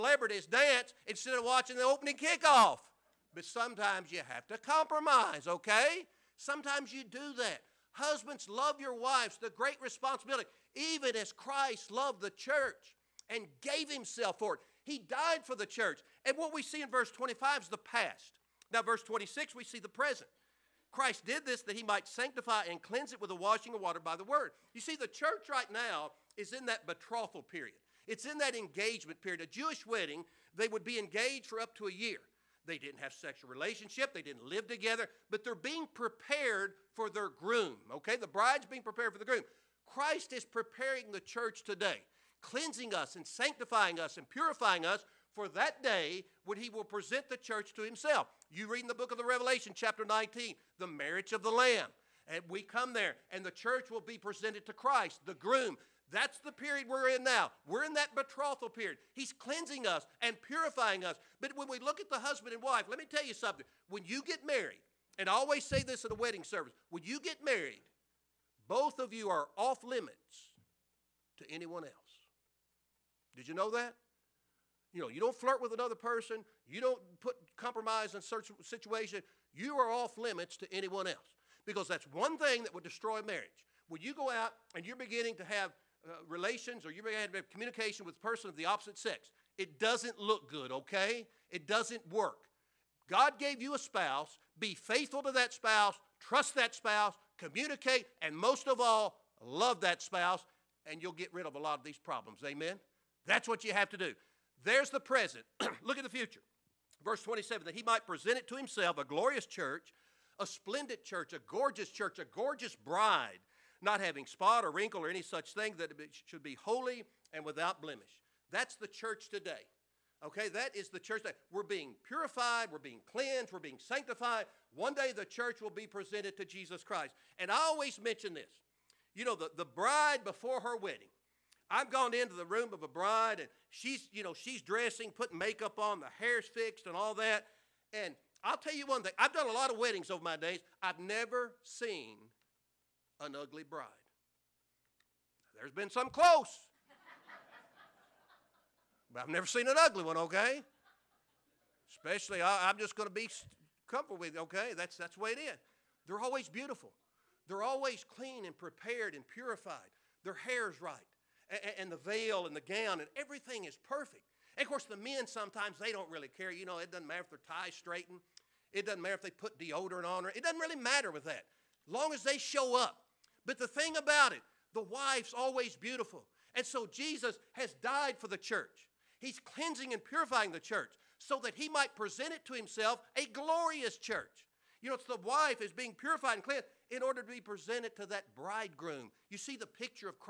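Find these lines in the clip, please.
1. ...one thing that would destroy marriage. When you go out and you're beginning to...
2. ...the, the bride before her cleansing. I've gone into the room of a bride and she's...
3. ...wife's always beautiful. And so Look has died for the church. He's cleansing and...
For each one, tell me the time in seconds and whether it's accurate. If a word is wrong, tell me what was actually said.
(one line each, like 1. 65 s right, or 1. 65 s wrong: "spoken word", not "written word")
1. 82 s right
2. 129 s wrong: "wedding", not "cleansing"
3. 174 s wrong: "Jesus", not "Look".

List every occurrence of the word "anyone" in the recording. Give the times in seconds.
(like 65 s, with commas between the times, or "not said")
71 s, 80 s.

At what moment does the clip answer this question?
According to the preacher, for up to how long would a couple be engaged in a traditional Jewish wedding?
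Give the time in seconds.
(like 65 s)
31 s.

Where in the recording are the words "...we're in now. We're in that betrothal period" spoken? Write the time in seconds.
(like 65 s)
56 s.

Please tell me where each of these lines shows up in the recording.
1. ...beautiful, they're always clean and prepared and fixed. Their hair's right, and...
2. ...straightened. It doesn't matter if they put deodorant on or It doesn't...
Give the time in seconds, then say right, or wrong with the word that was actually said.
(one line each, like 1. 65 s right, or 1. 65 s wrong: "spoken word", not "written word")
1. 156 s wrong: "purified", not "fixed"
2. 167 s right.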